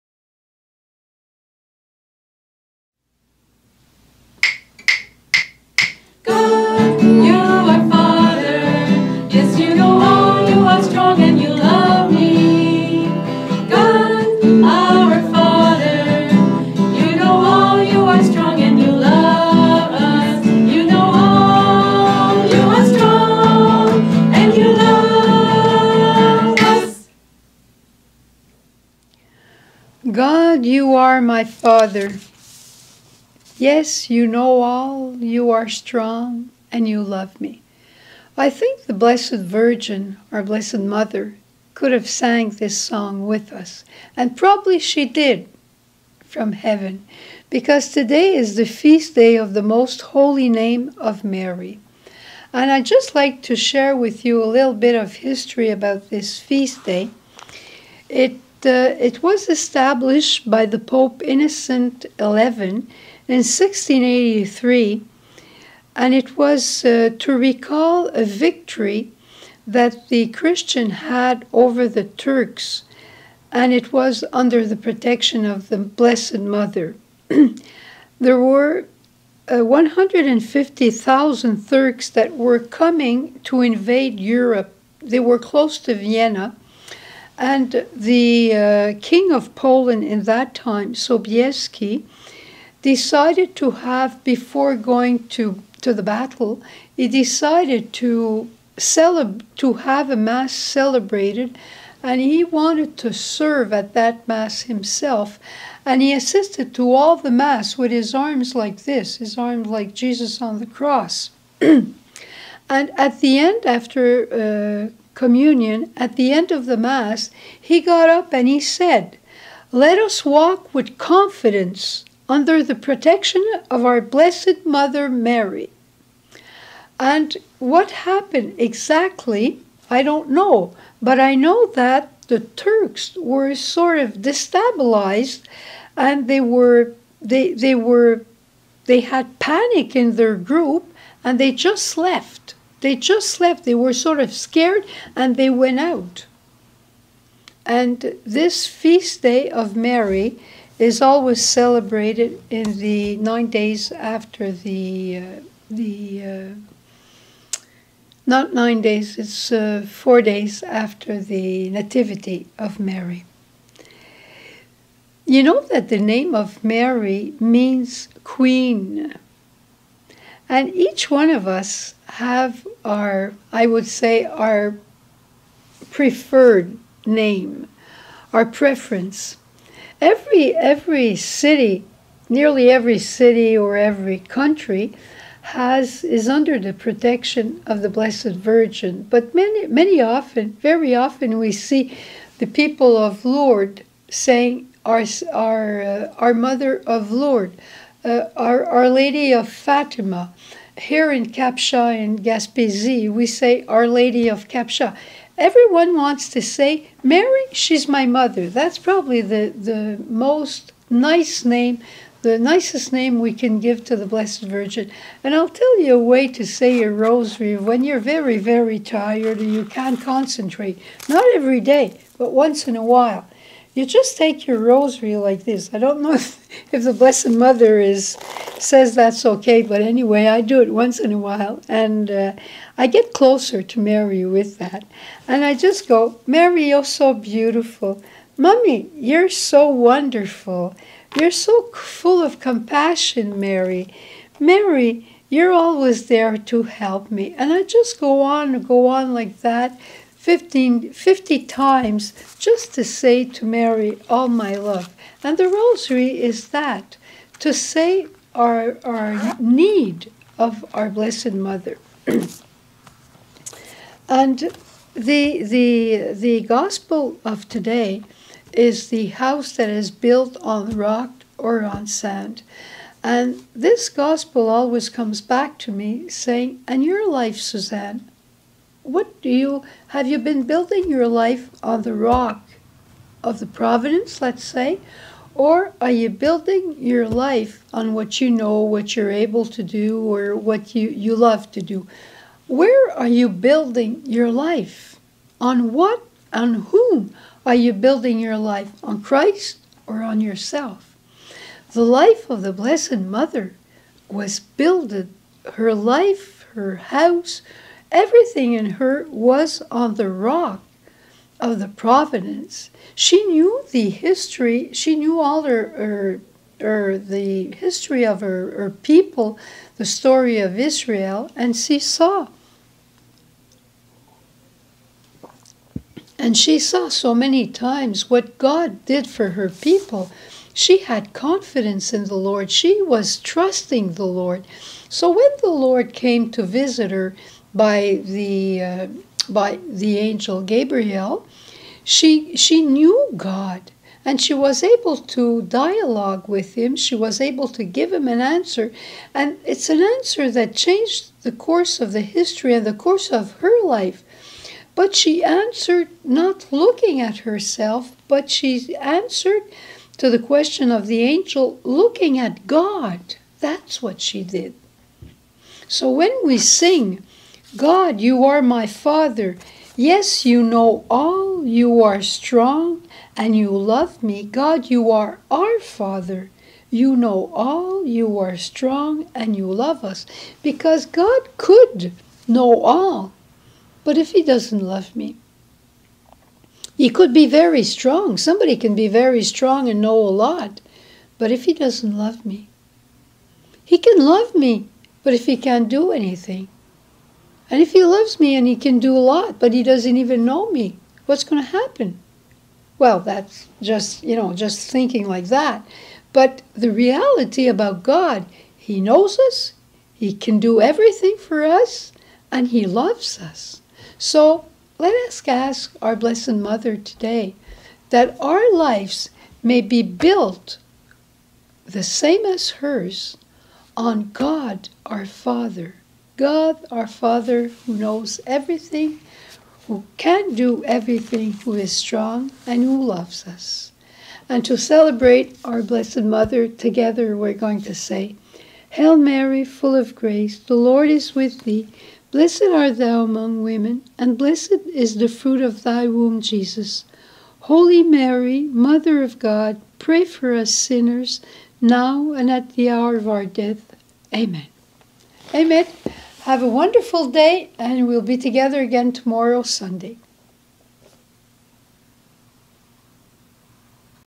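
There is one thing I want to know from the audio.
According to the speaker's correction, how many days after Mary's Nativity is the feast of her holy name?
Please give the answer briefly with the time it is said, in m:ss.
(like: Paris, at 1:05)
4, at 2:39.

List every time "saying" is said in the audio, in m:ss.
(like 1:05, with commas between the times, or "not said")
3:14, 4:36.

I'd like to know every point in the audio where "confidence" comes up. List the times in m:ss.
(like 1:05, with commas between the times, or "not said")
2:00, 5:31.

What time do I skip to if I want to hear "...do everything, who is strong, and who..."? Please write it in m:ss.
7:10.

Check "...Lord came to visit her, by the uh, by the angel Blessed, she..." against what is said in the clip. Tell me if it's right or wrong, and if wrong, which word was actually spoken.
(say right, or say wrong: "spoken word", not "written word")
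wrong: "Gabriel", not "Blessed".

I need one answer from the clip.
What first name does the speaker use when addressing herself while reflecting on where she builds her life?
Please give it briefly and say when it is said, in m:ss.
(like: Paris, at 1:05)
Suzanne, at 4:37.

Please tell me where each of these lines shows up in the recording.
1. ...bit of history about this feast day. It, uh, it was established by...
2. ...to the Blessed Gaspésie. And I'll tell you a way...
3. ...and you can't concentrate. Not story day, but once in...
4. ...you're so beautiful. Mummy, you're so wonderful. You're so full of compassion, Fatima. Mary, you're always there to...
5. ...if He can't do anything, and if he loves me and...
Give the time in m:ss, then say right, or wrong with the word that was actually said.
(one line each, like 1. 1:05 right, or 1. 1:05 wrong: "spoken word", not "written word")
1. 0:54 right
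2. 3:33 wrong: "Virgin", not "Gaspésie"
3. 3:39 wrong: "every", not "story"
4. 3:56 wrong: "Mary", not "Fatima"
5. 6:35 right.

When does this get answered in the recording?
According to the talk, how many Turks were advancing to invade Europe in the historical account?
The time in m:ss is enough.
1:19.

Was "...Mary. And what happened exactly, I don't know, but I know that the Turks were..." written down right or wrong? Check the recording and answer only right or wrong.
right.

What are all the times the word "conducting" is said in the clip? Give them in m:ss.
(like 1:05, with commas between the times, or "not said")
not said.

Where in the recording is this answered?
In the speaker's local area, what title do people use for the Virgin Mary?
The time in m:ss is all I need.
3:23.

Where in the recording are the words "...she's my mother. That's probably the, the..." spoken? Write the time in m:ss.
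3:27.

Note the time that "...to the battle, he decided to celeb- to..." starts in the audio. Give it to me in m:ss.
1:35.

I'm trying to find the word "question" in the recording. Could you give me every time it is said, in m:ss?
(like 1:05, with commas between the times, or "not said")
6:00.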